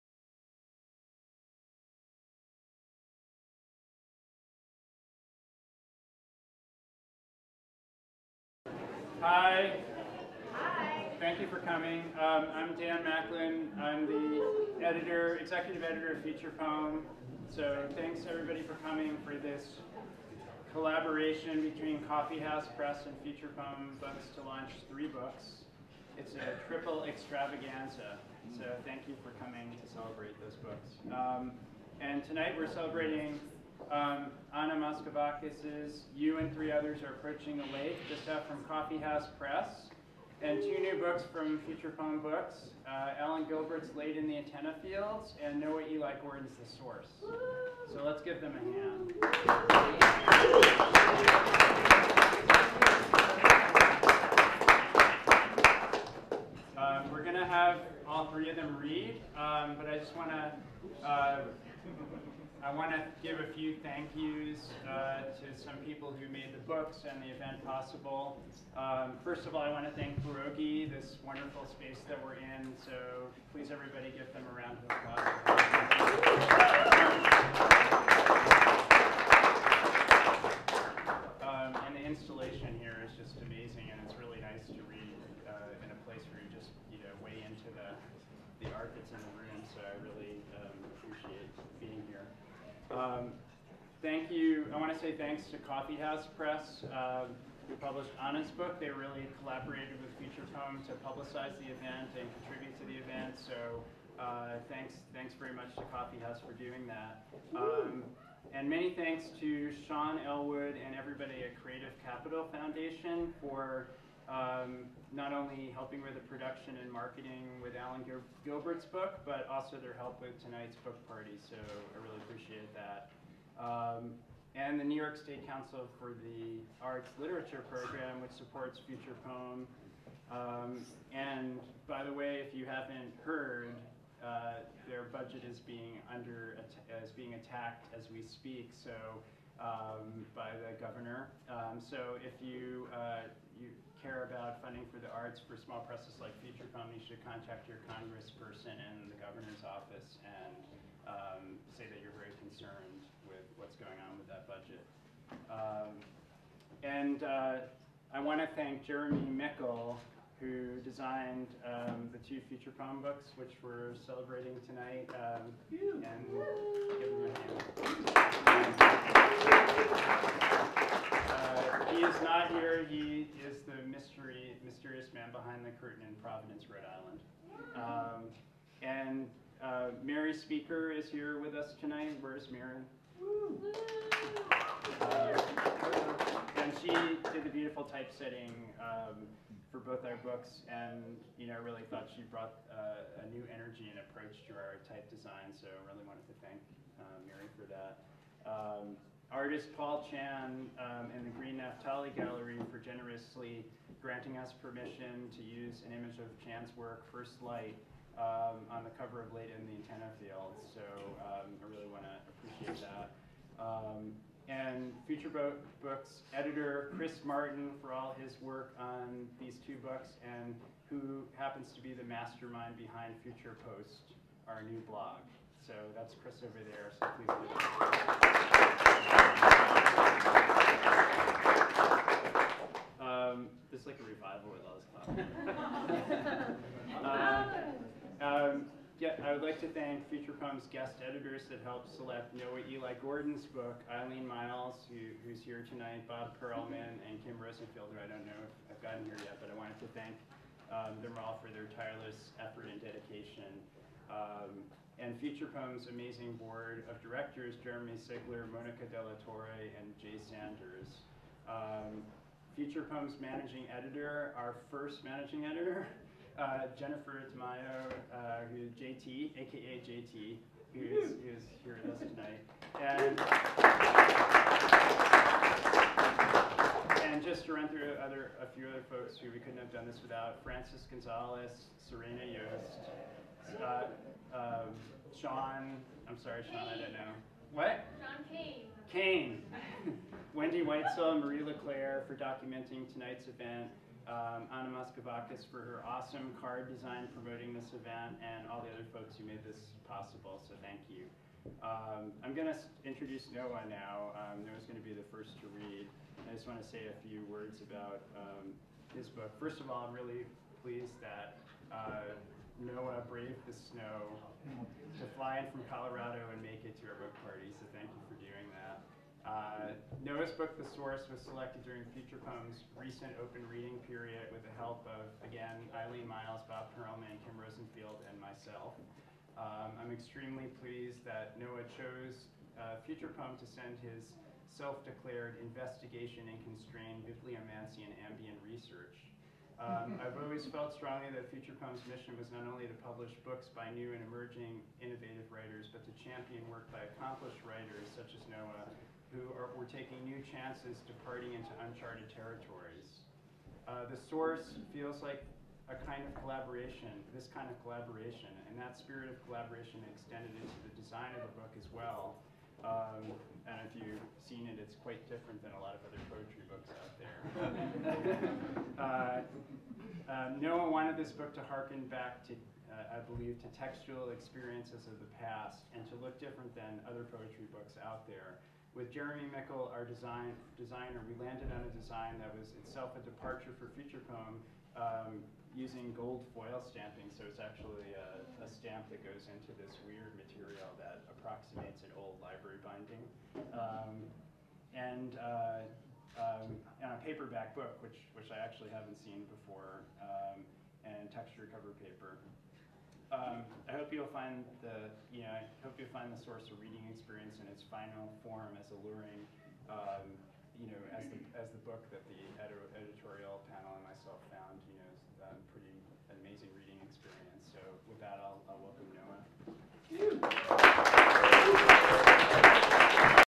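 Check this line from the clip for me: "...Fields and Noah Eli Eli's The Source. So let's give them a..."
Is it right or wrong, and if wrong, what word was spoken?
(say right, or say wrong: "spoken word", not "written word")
wrong: "Gordon", not "Eli".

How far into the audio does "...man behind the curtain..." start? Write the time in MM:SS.
02:55.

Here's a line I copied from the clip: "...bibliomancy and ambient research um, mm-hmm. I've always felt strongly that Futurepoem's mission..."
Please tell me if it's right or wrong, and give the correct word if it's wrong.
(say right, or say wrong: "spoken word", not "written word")
right.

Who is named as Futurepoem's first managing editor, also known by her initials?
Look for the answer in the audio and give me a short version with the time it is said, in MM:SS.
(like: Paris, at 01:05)
Jennifer Tamayo, at 04:26.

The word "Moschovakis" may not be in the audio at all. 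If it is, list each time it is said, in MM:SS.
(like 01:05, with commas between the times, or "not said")
00:34, 04:54.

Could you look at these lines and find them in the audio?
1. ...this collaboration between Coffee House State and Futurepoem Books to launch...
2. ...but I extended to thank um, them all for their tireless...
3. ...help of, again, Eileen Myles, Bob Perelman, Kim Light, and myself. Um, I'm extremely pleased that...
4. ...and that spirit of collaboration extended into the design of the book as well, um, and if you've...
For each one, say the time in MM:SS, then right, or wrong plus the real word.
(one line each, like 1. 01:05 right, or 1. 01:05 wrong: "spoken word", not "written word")
1. 00:19 wrong: "Press", not "State"
2. 04:09 wrong: "wanted", not "extended"
3. 05:24 wrong: "Rosenfield", not "Light"
4. 05:58 right.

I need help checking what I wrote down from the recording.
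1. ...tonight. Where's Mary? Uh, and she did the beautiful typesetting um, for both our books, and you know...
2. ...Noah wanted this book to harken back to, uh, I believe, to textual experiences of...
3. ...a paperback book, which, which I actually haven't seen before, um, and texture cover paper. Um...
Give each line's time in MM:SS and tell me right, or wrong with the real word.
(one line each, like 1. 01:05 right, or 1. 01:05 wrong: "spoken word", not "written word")
1. 03:01 right
2. 06:10 right
3. 06:36 right.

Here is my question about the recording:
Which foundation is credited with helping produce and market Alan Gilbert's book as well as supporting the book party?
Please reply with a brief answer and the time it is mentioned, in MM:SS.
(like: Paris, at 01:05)
Creative Capital Foundation, at 01:51.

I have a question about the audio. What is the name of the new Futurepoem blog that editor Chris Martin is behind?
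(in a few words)
Future Post.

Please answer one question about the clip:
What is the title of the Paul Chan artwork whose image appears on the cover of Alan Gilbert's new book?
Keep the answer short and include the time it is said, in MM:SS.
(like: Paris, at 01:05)
First Light, at 03:27.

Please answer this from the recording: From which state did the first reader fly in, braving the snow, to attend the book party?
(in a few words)
Colorado.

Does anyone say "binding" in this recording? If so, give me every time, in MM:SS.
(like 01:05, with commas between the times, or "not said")
06:32.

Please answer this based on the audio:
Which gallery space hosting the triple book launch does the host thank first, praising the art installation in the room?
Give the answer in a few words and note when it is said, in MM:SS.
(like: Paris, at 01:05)
Pierogi, at 01:10.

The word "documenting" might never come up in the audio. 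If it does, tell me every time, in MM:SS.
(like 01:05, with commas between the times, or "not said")
04:52.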